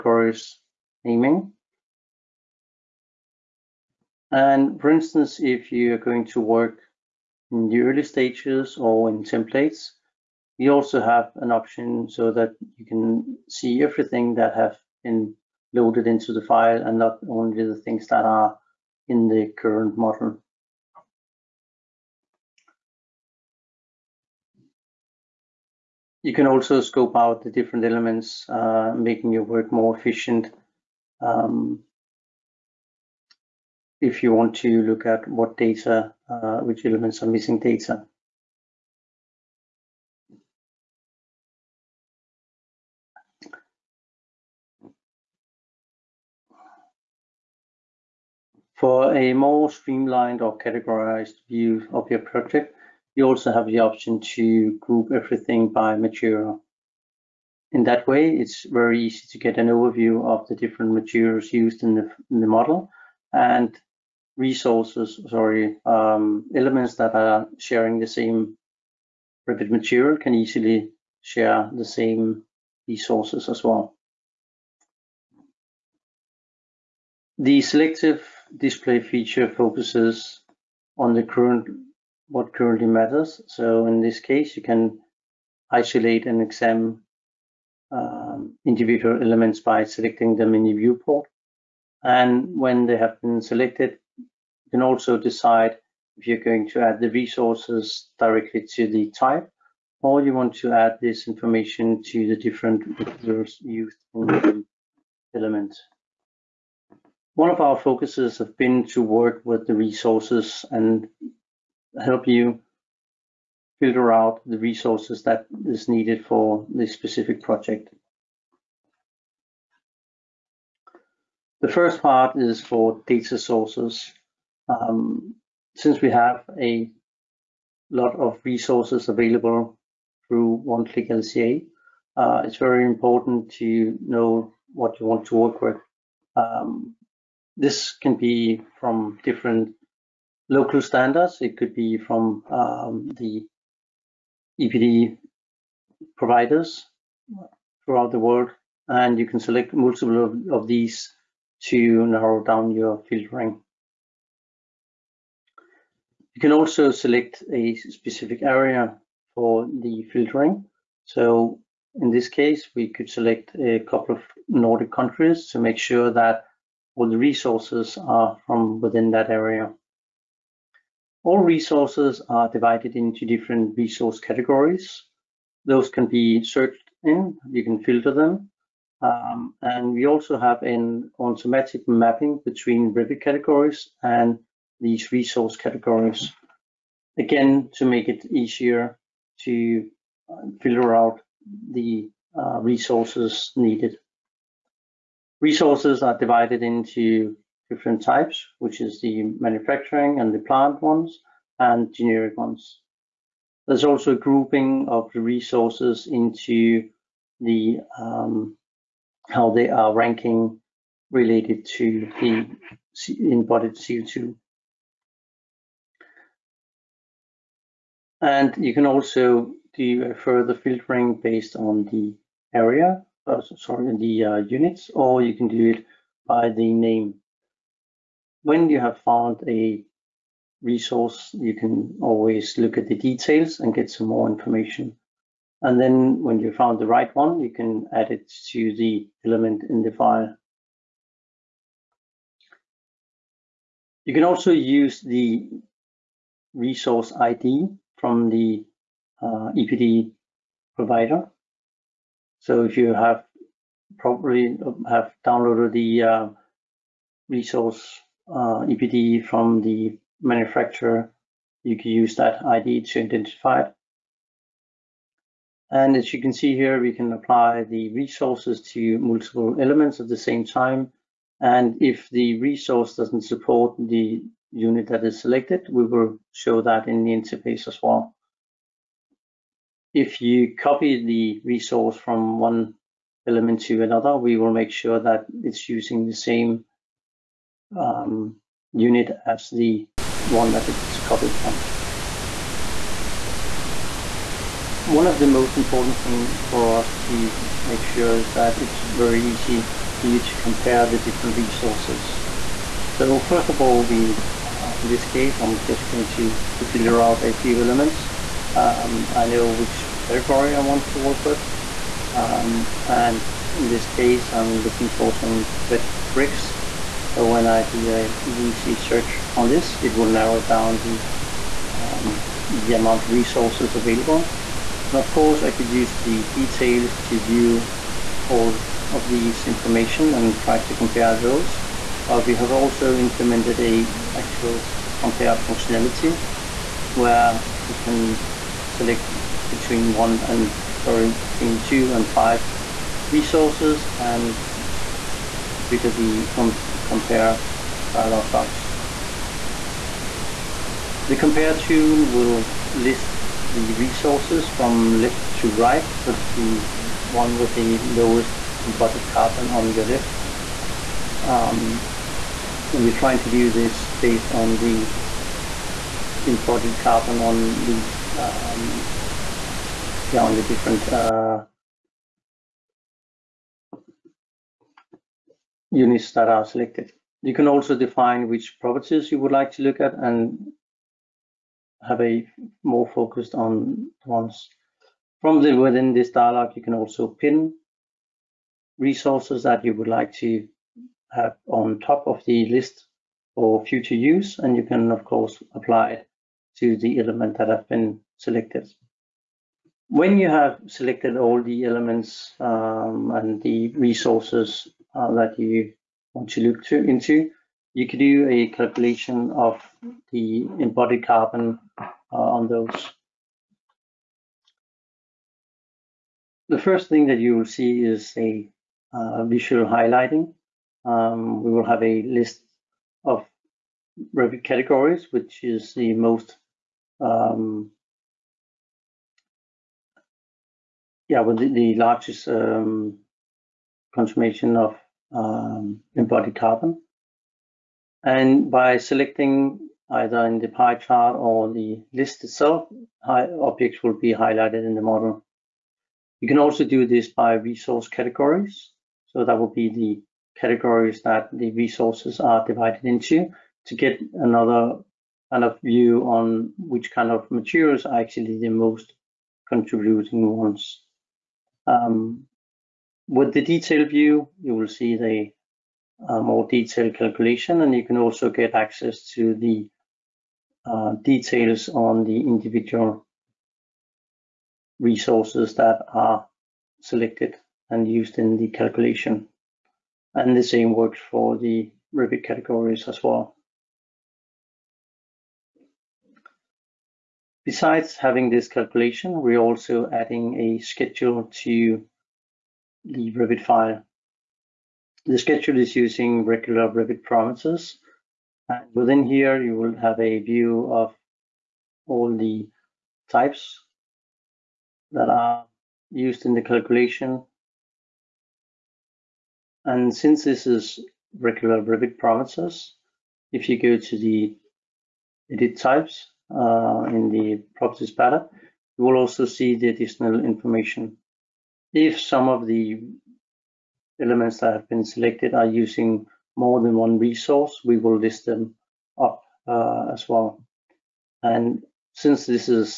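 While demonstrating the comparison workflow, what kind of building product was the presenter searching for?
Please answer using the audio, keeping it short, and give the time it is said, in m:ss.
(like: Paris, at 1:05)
Red bricks, at 5:15.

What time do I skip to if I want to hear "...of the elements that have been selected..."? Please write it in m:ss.
8:42.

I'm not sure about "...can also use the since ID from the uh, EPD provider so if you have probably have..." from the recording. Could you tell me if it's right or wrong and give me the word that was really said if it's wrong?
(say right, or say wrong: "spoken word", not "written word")
wrong: "resource", not "since".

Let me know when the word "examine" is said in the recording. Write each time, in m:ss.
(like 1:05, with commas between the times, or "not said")
1:26.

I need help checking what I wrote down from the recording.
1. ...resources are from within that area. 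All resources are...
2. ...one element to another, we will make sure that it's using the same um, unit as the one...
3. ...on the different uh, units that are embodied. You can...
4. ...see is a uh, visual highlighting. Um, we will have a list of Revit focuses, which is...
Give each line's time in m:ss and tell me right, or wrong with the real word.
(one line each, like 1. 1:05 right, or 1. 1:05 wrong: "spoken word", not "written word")
1. 2:47 right
2. 4:42 right
3. 6:10 wrong: "selected", not "embodied"
4. 6:57 wrong: "categories", not "focuses".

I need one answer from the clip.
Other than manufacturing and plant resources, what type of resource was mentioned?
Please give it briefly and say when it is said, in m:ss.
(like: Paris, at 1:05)
Generic, at 3:21.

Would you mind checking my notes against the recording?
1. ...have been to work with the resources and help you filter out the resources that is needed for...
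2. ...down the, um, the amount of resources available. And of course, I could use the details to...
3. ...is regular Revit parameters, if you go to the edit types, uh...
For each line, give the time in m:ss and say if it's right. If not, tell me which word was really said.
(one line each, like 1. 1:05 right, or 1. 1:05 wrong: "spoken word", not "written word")
1. 1:48 right
2. 5:20 right
3. 8:30 right.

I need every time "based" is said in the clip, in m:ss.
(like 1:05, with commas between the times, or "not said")
3:41, 6:03.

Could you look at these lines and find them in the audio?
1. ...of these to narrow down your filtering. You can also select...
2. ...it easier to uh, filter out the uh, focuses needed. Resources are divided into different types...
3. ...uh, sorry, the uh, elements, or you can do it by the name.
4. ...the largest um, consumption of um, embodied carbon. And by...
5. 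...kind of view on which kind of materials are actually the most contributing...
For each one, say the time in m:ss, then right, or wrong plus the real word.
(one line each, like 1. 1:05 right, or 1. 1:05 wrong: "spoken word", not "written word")
1. 2:30 right
2. 3:08 wrong: "resources", not "focuses"
3. 3:43 wrong: "units", not "elements"
4. 7:11 right
5. 7:35 right.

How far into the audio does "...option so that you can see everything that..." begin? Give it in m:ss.
0:11.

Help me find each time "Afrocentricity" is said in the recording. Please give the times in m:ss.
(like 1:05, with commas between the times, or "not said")
not said.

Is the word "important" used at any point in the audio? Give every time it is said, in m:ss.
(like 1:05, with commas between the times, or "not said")
2:12, 4:55.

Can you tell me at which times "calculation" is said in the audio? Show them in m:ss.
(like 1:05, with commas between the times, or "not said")
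6:48, 7:46, 7:58, 8:08, 8:26.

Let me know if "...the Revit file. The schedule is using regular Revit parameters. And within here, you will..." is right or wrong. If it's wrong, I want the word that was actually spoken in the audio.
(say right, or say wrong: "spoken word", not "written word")
right.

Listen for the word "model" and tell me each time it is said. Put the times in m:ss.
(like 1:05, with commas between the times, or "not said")
0:19, 1:02, 7:24.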